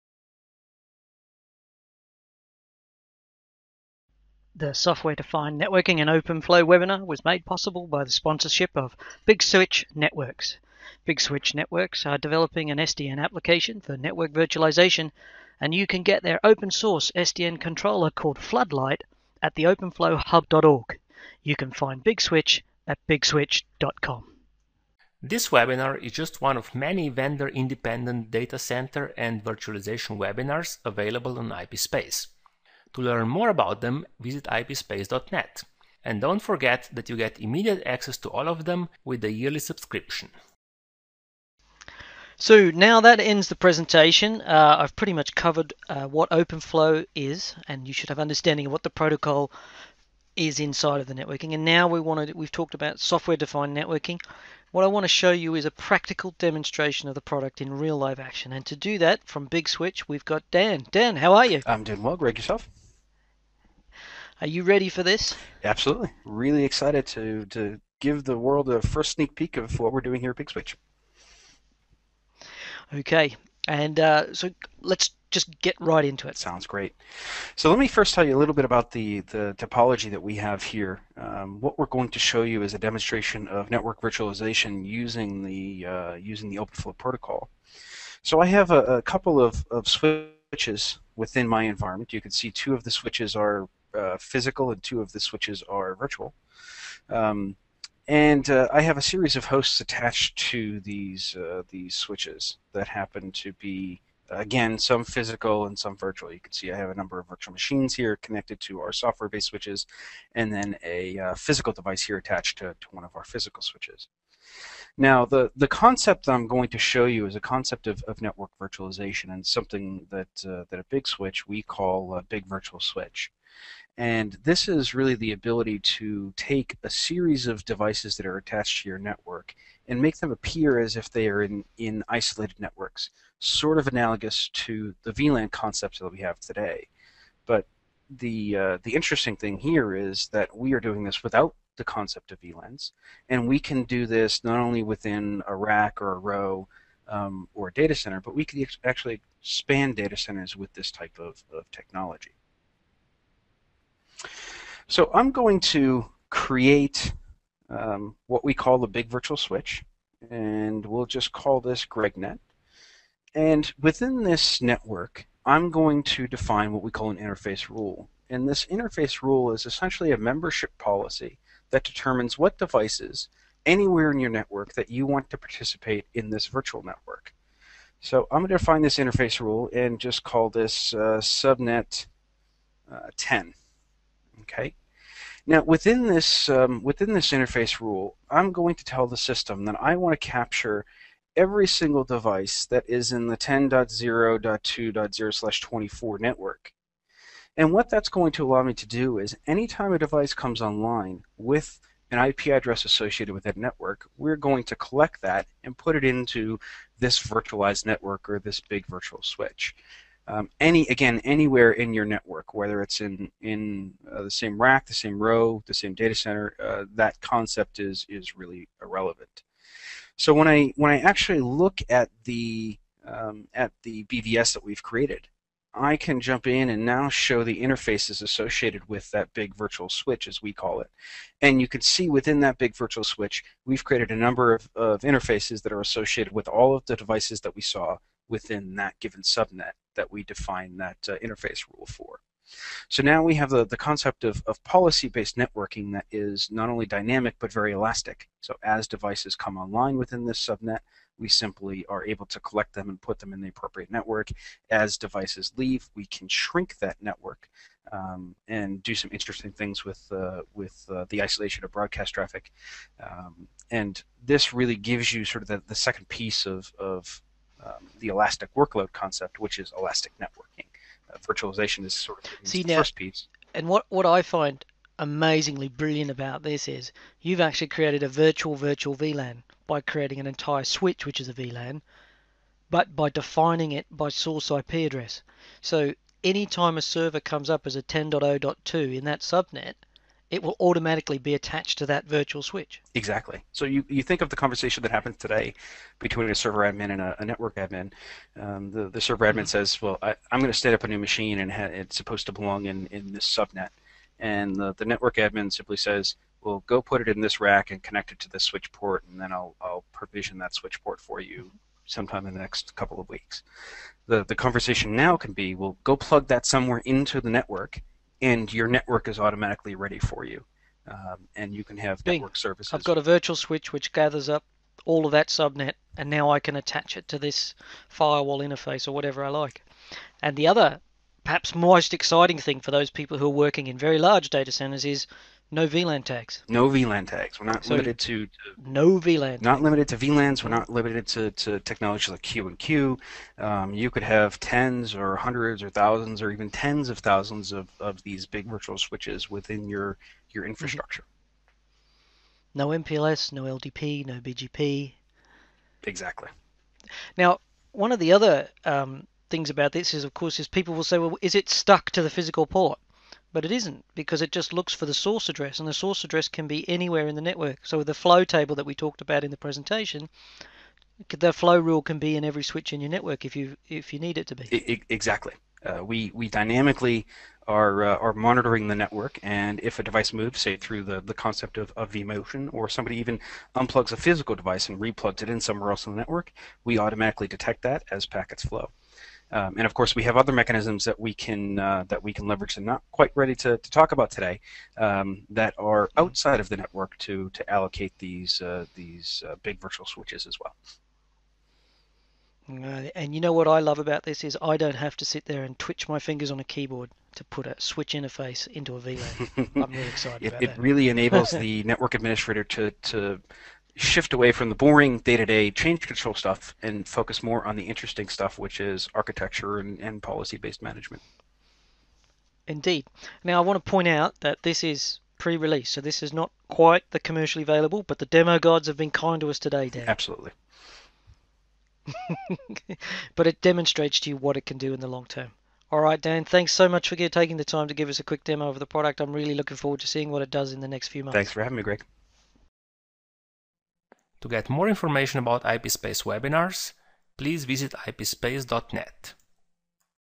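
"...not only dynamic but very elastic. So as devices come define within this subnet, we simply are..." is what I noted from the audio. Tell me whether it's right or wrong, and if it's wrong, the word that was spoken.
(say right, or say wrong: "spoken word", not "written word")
wrong: "online", not "define".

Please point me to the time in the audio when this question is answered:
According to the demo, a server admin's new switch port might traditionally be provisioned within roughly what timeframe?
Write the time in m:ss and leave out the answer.
5:12.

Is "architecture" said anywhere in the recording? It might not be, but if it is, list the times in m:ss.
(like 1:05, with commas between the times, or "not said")
6:58.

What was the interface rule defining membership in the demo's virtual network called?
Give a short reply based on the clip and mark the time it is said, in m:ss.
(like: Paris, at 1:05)
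subnet 10, at 3:01.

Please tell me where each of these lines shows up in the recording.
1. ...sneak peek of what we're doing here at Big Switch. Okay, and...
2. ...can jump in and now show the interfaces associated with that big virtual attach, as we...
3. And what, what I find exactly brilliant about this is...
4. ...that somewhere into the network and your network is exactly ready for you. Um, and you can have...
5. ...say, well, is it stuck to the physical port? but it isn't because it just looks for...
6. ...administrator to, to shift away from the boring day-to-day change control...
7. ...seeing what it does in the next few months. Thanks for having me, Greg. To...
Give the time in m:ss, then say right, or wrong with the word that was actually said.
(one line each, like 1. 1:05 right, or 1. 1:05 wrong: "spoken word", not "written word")
1. 1:09 right
2. 3:45 wrong: "switch", not "attach"
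3. 4:33 wrong: "amazingly", not "exactly"
4. 5:16 wrong: "automatically", not "exactly"
5. 6:00 right
6. 6:51 right
7. 7:19 right.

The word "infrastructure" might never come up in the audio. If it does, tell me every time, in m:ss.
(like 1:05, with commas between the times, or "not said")
5:50.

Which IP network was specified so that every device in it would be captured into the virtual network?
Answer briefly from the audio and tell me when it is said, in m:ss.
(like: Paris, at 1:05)
10.0.2.0/24, at 3:13.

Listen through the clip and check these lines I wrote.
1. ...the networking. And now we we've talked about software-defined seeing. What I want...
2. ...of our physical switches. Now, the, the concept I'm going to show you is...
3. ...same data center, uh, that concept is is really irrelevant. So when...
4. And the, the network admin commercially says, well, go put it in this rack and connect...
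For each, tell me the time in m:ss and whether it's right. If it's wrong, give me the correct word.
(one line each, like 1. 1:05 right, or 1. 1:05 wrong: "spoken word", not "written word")
1. 0:51 wrong: "networking", not "seeing"
2. 1:53 right
3. 3:35 right
4. 5:04 wrong: "simply", not "commercially".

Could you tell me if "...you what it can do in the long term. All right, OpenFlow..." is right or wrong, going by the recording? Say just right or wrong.
wrong.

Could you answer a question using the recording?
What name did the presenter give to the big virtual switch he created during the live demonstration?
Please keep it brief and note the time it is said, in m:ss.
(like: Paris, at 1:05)
GregNet, at 2:41.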